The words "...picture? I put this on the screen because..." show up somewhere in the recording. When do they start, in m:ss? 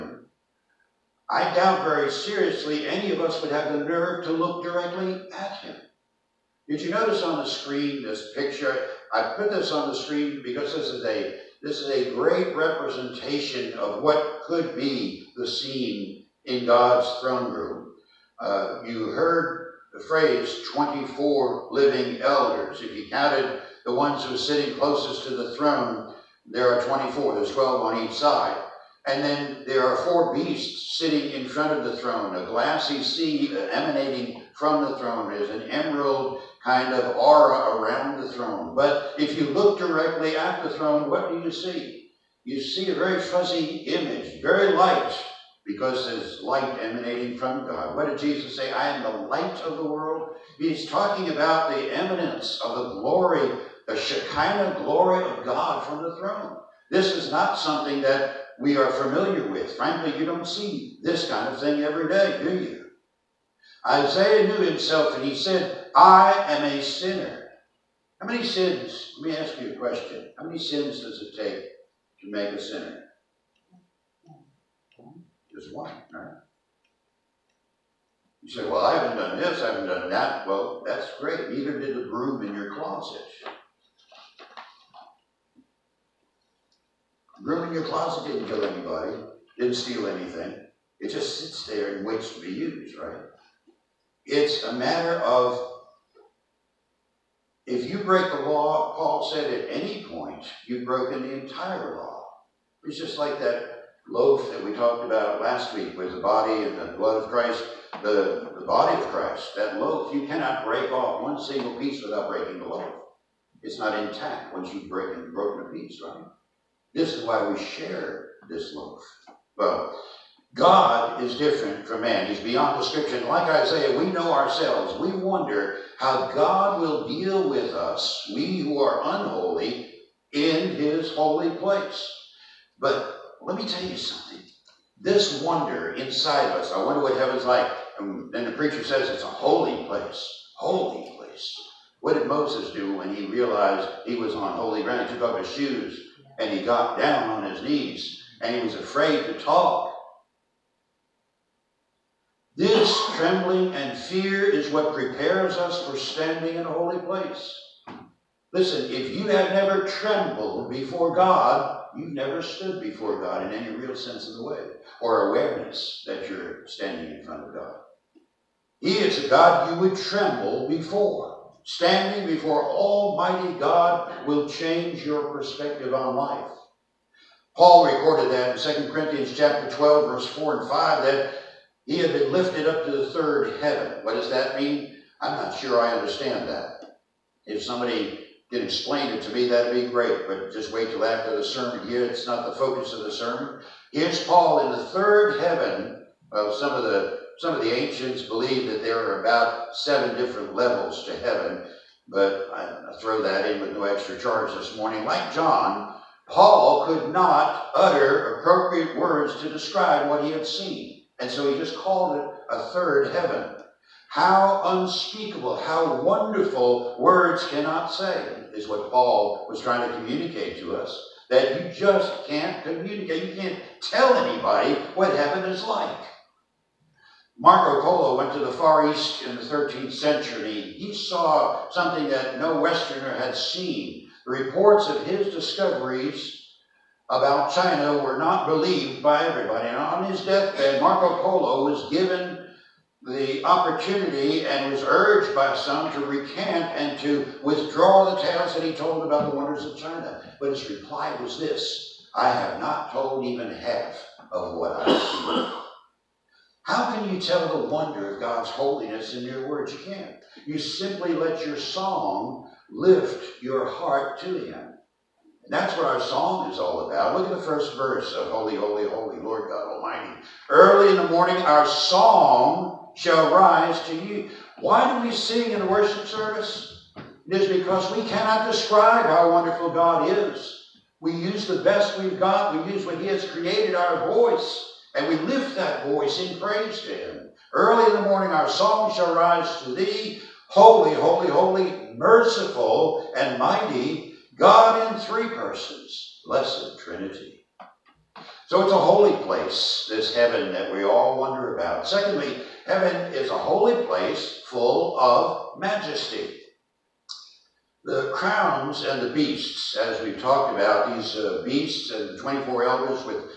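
0:08.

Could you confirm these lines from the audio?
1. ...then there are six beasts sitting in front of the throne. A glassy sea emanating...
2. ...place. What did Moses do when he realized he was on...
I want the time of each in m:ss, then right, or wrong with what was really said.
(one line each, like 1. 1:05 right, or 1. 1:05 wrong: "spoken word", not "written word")
1. 0:29 wrong: "four", not "six"
2. 2:21 right.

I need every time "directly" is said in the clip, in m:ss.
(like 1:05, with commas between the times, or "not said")
0:04, 0:39.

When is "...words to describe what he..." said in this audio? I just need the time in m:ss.
3:28.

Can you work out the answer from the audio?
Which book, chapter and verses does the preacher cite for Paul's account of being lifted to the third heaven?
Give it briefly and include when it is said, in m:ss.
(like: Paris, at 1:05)
2 Corinthians 12:4-5, at 2:58.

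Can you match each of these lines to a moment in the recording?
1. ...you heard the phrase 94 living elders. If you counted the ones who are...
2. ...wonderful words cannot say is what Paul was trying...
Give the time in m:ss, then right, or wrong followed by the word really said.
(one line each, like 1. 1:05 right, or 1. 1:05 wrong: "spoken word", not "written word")
1. 0:18 wrong: "24", not "94"
2. 3:36 right.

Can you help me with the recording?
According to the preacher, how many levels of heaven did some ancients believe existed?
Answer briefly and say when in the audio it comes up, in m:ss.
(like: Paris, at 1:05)
7, at 3:19.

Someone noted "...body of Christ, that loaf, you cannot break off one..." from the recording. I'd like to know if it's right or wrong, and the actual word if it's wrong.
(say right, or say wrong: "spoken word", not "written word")
right.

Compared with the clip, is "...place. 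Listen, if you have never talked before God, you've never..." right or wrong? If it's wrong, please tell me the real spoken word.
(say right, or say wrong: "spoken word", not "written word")
wrong: "trembled", not "talked".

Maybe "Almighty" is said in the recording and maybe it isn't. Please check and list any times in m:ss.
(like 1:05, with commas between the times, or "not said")
2:52, 4:29.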